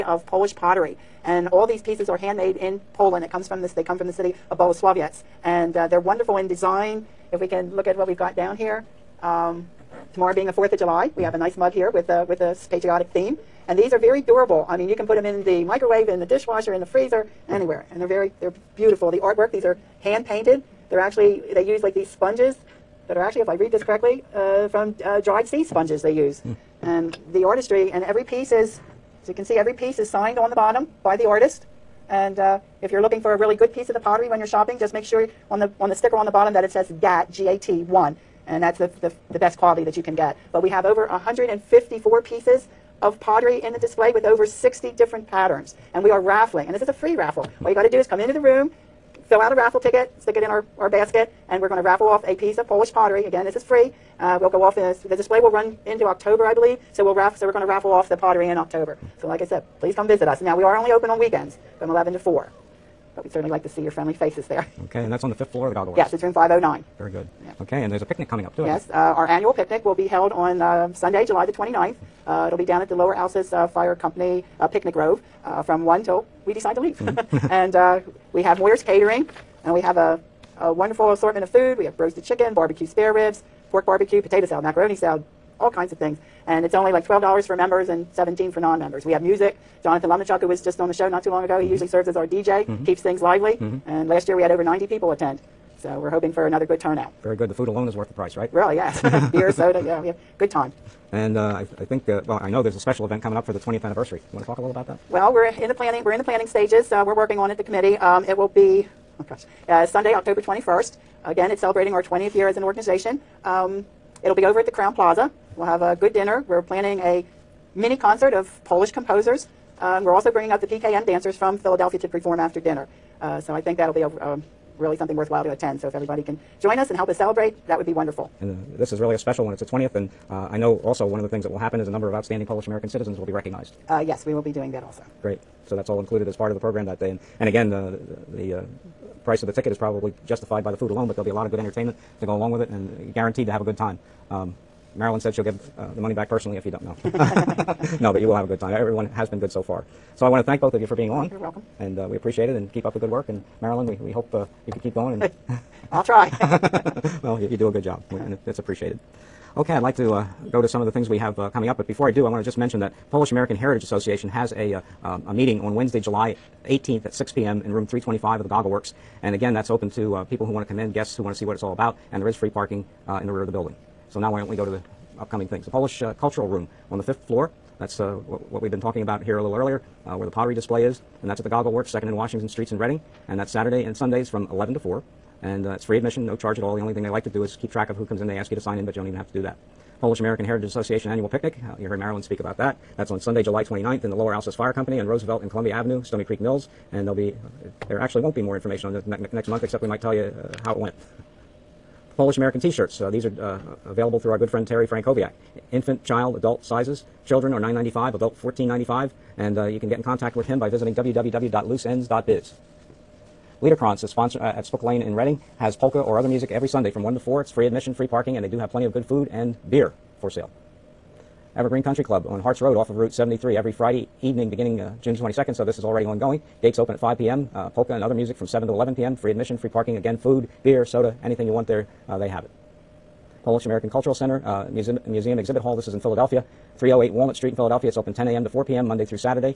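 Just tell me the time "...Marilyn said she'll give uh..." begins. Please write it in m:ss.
2:24.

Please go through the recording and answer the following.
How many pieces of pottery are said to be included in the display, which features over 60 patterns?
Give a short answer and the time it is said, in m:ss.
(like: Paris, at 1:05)
154, at 0:41.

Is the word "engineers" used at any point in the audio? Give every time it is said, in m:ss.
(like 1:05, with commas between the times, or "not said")
not said.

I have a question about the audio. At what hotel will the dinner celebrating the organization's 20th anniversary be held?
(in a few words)
Crowne Plaza.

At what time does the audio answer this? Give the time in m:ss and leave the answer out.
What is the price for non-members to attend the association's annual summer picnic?
1:28.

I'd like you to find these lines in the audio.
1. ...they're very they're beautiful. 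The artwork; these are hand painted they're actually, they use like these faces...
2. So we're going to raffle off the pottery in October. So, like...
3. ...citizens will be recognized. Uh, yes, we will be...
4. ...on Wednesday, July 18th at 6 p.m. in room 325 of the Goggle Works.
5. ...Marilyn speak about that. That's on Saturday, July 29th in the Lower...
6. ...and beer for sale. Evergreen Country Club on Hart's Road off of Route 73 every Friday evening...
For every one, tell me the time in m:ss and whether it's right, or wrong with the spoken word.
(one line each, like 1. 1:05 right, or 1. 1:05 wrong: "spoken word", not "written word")
1. 0:18 wrong: "sponges", not "faces"
2. 0:57 right
3. 2:12 right
4. 2:45 right
5. 3:11 wrong: "Sunday", not "Saturday"
6. 3:39 right.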